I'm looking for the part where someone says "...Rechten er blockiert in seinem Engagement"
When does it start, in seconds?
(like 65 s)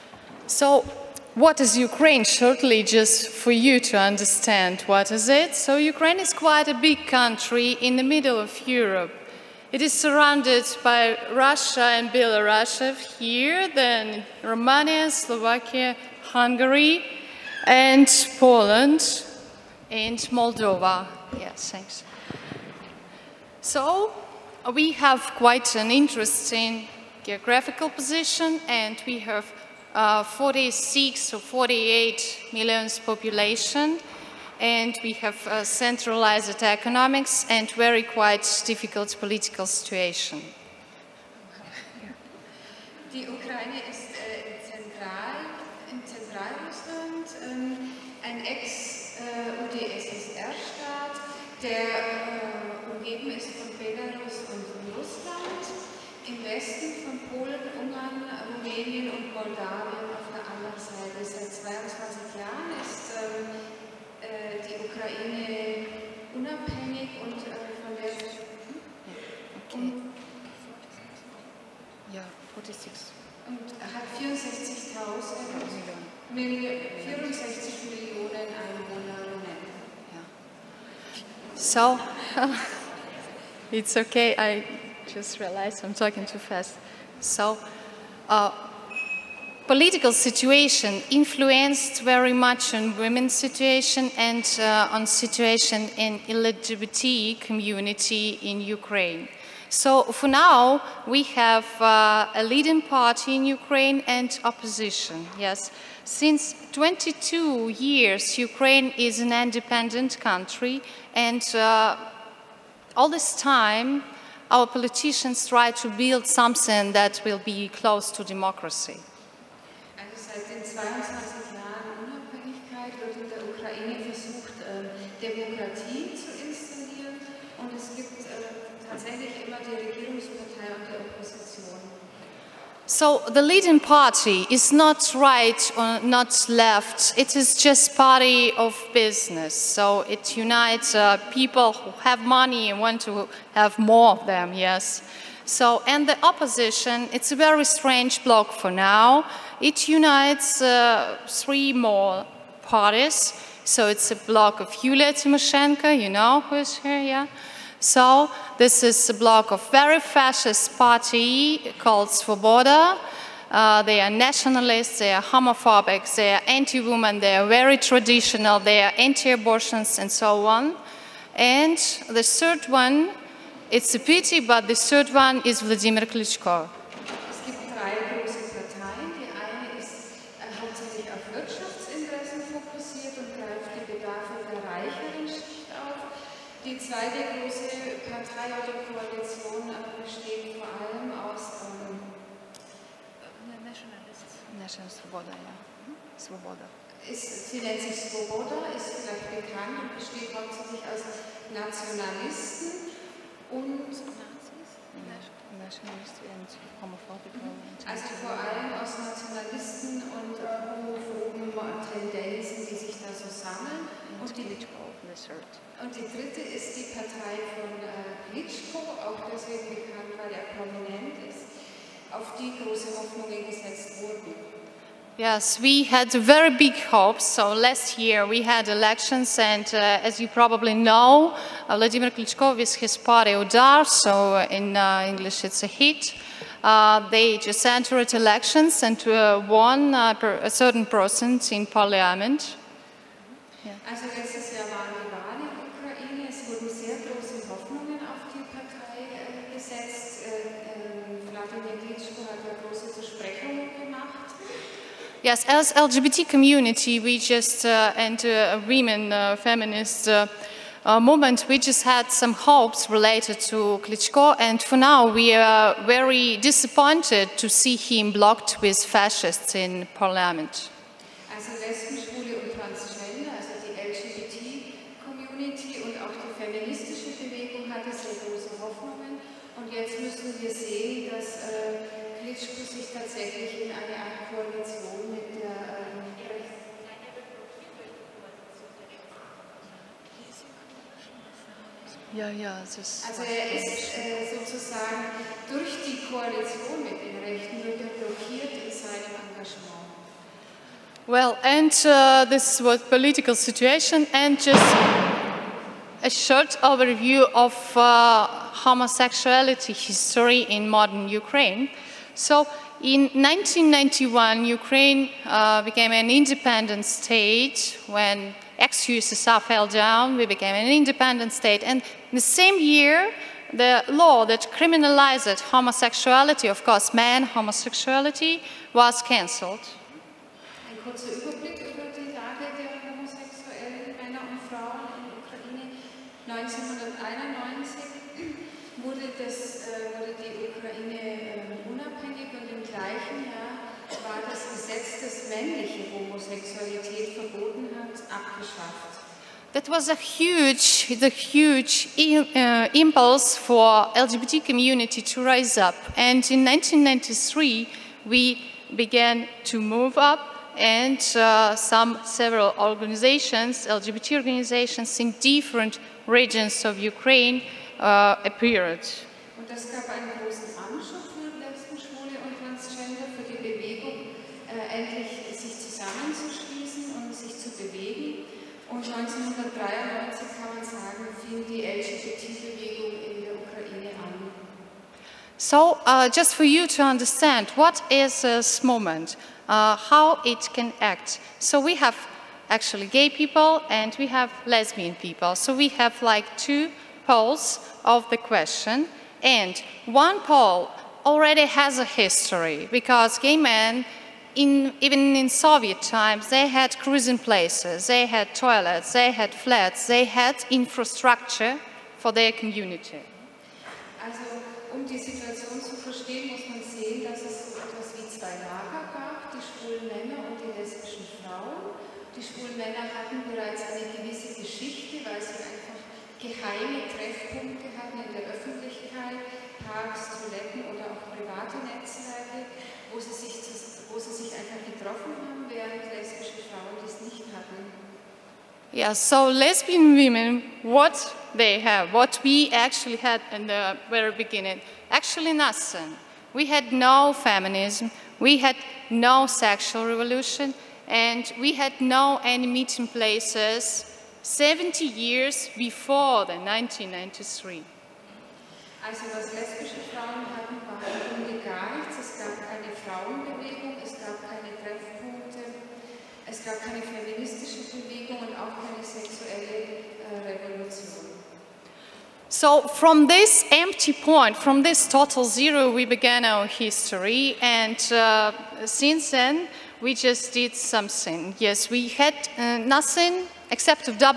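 297 s.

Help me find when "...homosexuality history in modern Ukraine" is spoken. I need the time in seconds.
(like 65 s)
308 s.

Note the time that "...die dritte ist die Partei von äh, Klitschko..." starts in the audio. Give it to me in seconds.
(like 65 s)
215 s.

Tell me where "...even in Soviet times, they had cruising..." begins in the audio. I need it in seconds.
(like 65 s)
404 s.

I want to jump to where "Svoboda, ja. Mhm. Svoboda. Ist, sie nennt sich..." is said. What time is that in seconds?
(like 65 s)
195 s.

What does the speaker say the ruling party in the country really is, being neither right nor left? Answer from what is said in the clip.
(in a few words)
party of business.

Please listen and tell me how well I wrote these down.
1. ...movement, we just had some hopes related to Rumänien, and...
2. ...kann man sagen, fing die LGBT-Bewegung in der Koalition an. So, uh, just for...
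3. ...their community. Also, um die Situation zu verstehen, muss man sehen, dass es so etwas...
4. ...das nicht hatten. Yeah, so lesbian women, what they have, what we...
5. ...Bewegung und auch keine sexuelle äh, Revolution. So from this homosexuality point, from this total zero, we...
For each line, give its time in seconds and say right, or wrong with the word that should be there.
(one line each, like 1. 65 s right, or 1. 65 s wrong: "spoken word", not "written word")
1. 260 s wrong: "Klitschko", not "Rumänien"
2. 380 s wrong: "Ukraine", not "Koalition"
3. 412 s right
4. 436 s right
5. 467 s wrong: "empty", not "homosexuality".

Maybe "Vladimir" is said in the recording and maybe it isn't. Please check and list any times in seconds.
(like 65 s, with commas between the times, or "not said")
175 s, 231 s.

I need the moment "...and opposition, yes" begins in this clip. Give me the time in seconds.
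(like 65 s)
104 s.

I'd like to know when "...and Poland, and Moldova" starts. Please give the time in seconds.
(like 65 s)
17 s.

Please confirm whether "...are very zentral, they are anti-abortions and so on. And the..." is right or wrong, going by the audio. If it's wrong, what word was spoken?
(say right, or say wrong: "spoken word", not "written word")
wrong: "traditional", not "zentral".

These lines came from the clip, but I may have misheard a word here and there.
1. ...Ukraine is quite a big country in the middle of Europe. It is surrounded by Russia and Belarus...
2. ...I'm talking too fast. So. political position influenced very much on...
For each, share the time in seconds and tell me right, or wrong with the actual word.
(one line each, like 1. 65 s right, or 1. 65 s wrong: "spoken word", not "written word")
1. 5 s right
2. 85 s wrong: "situation", not "position".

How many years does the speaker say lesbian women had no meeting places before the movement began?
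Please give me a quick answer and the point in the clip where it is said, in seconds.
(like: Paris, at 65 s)
70, at 454 s.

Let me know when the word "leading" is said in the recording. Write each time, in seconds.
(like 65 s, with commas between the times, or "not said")
102 s, 133 s.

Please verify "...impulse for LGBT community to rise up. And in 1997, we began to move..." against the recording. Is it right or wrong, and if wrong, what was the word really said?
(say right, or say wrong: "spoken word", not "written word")
wrong: "1993", not "1997".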